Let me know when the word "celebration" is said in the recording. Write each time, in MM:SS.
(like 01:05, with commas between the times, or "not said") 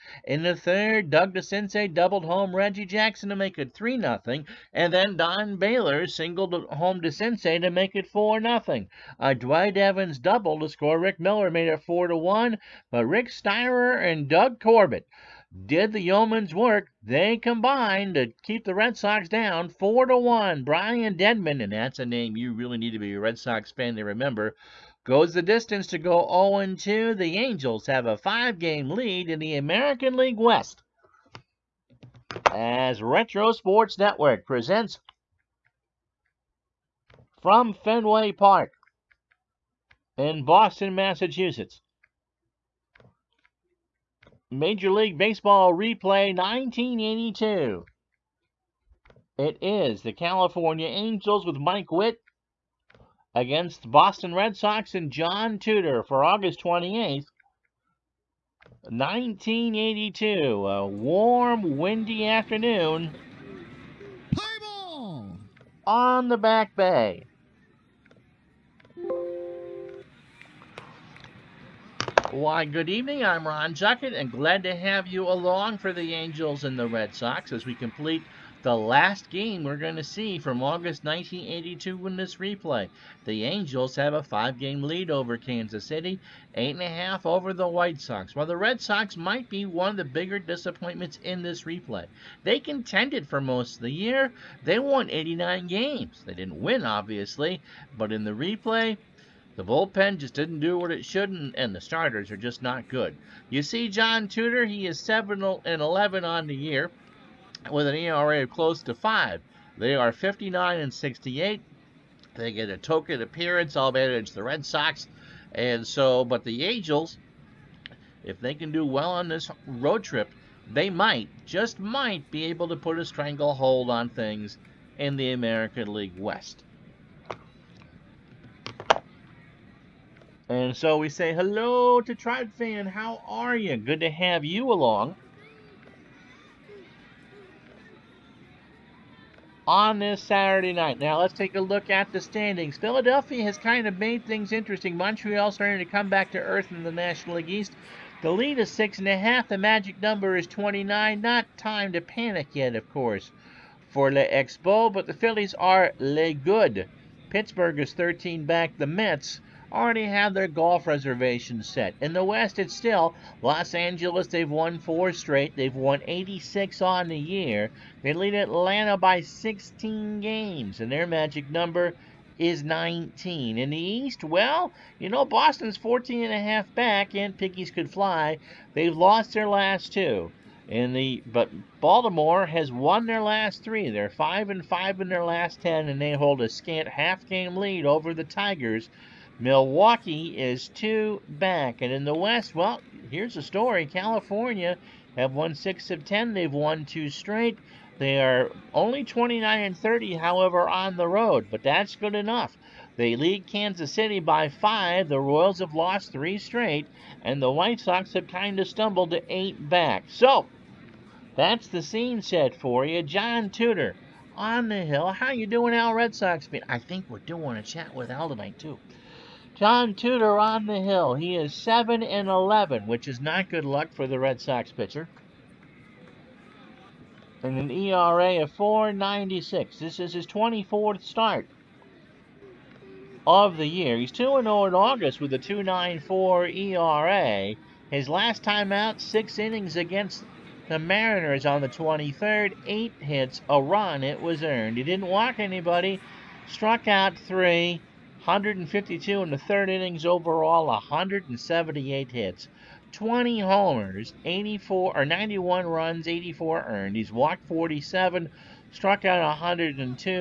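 not said.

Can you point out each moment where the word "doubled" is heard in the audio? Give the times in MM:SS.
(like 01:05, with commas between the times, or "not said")
00:01, 00:10.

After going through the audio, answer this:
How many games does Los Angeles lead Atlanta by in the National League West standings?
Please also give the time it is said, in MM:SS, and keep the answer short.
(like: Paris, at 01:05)
16 games, at 02:49.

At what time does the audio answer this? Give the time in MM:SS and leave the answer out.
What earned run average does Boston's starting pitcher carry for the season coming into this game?
03:48.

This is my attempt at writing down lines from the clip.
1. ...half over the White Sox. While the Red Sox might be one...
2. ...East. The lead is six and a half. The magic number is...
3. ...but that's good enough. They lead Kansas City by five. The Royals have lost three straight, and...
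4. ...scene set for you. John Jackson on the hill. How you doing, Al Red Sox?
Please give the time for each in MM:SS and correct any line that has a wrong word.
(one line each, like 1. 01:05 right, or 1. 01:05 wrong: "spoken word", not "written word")
1. 01:26 right
2. 02:27 right
3. 03:21 right
4. 03:31 wrong: "Tudor", not "Jackson".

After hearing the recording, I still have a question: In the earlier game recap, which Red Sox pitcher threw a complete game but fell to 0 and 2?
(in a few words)
Brian Denman.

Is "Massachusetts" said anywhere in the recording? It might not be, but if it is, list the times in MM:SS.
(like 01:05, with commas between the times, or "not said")
00:40.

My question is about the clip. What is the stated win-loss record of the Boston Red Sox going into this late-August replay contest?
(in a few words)
59 and 68.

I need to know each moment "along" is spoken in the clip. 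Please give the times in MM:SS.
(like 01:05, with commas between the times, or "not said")
01:15, 02:14.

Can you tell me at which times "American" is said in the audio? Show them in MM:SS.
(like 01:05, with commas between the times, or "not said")
00:29, 02:05.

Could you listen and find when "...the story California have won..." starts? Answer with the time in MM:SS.
03:13.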